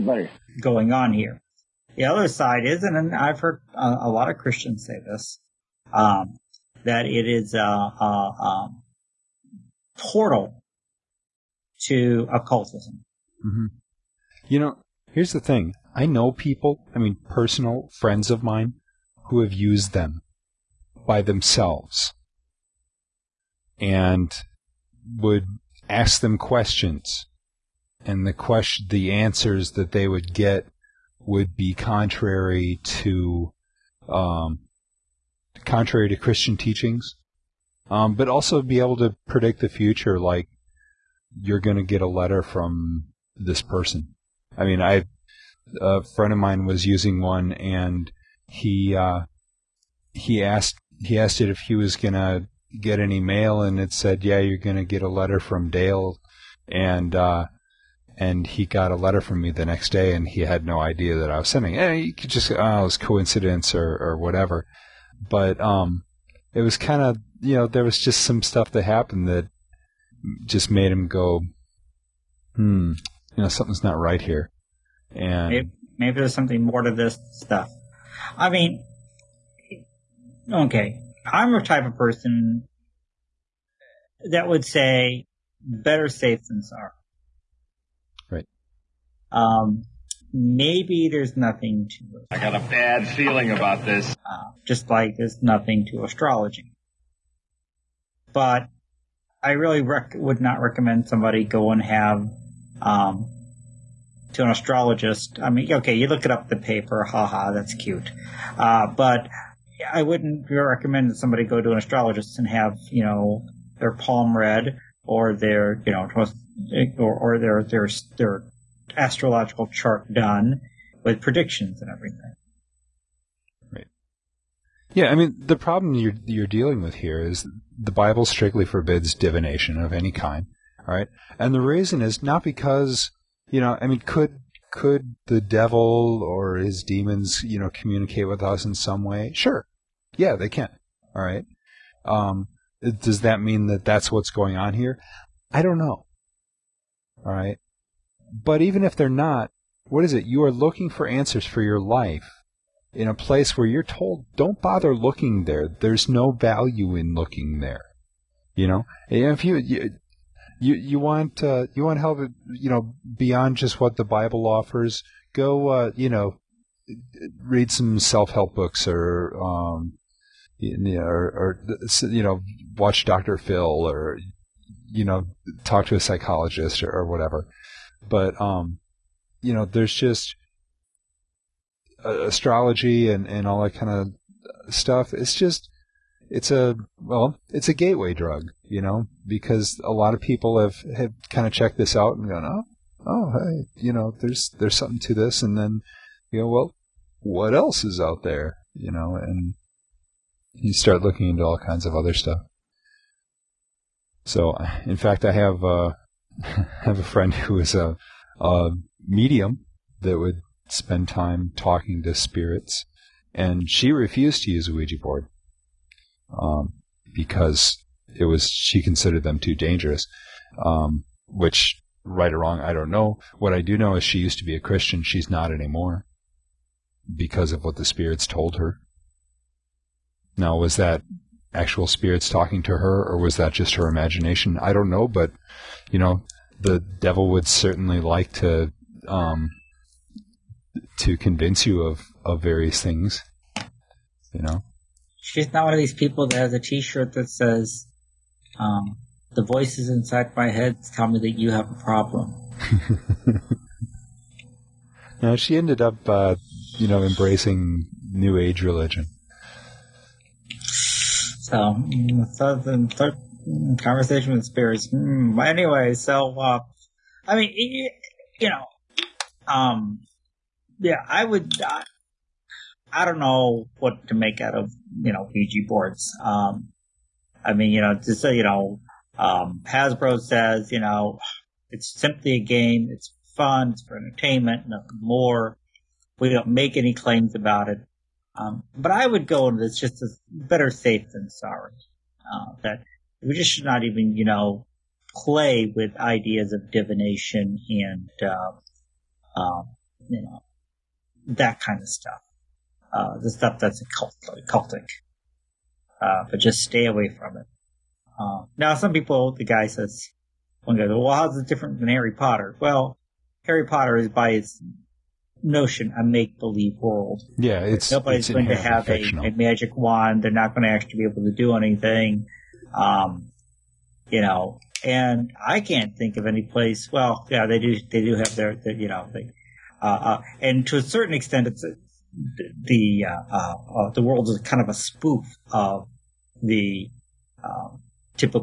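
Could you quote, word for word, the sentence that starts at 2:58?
But um you know there's just astrology and, and all that kind of stuff.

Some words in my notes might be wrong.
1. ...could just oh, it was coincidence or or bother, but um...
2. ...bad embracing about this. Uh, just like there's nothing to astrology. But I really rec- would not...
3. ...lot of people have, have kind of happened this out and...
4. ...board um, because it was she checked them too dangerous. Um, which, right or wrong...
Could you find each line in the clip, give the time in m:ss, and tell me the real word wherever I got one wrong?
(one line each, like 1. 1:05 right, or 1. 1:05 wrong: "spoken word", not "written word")
1. 1:02 wrong: "whatever", not "bother"
2. 1:32 wrong: "feeling", not "embracing"
3. 3:09 wrong: "checked", not "happened"
4. 3:35 wrong: "considered", not "checked".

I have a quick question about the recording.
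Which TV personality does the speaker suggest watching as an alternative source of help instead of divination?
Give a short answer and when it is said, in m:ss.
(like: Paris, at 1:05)
Doctor Phil, at 2:53.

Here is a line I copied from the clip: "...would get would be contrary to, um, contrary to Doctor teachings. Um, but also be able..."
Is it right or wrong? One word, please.
wrong.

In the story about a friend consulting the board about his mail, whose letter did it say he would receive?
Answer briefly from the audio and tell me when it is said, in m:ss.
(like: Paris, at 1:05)
Dale, at 0:55.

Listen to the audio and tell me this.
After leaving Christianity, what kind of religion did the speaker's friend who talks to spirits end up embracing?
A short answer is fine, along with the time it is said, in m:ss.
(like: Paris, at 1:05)
New Age religion, at 4:18.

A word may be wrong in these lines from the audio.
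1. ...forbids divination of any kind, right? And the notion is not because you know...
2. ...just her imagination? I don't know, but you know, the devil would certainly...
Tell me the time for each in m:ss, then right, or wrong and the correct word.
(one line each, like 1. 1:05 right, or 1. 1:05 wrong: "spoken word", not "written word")
1. 2:08 wrong: "reason", not "notion"
2. 3:53 right.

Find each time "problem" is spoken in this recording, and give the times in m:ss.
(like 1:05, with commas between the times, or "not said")
2:05, 4:11.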